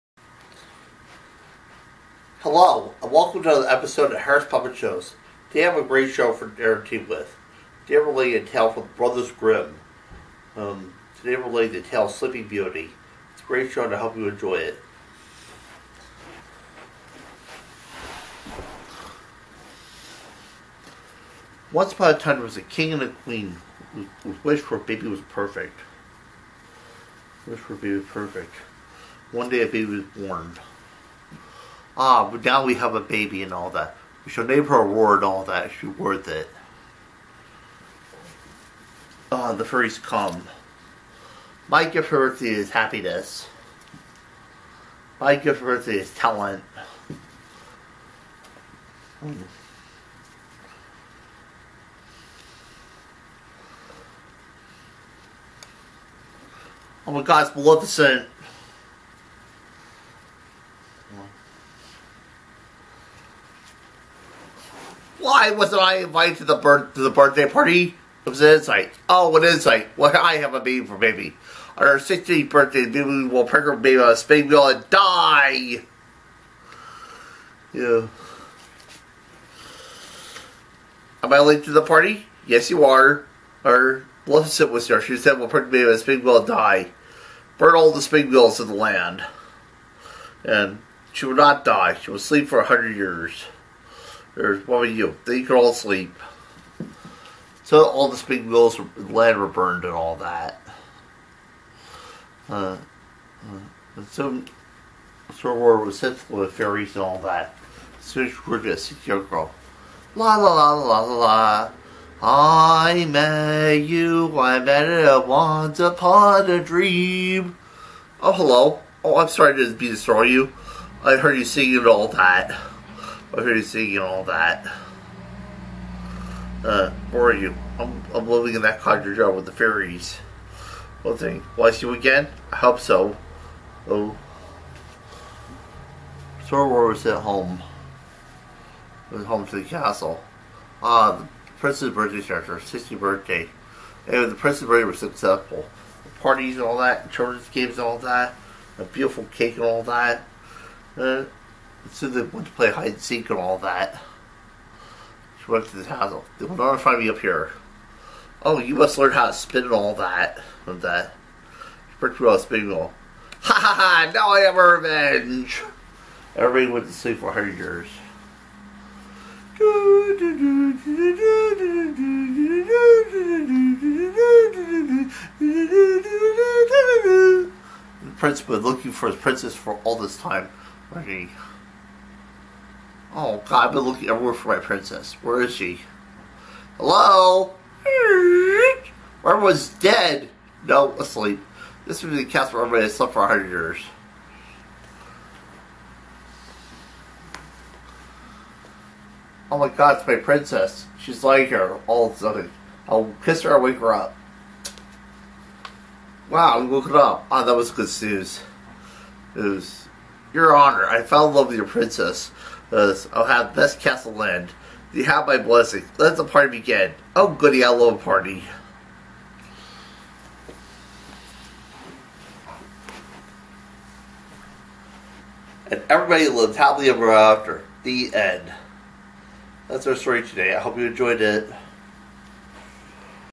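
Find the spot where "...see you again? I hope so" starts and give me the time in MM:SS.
02:11.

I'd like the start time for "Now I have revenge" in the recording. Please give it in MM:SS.
02:44.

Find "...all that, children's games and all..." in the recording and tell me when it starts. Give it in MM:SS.
02:26.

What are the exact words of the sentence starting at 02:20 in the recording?
Ah, the prince's birthday character, 60th birthday.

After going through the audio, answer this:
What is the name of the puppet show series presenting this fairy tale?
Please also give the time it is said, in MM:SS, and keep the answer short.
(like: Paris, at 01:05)
Harris Puppet Shows, at 00:04.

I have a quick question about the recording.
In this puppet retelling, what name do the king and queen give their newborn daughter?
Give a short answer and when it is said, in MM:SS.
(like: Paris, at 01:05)
Aurora, at 00:34.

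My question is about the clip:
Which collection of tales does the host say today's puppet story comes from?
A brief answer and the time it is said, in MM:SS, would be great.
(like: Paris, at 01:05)
Brothers Grimm, at 00:08.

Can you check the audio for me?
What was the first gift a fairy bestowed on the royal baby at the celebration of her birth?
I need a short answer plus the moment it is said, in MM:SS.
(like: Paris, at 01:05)
Happiness, at 00:42.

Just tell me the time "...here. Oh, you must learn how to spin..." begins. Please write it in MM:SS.
02:37.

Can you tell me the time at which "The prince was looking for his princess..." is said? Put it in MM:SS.
02:58.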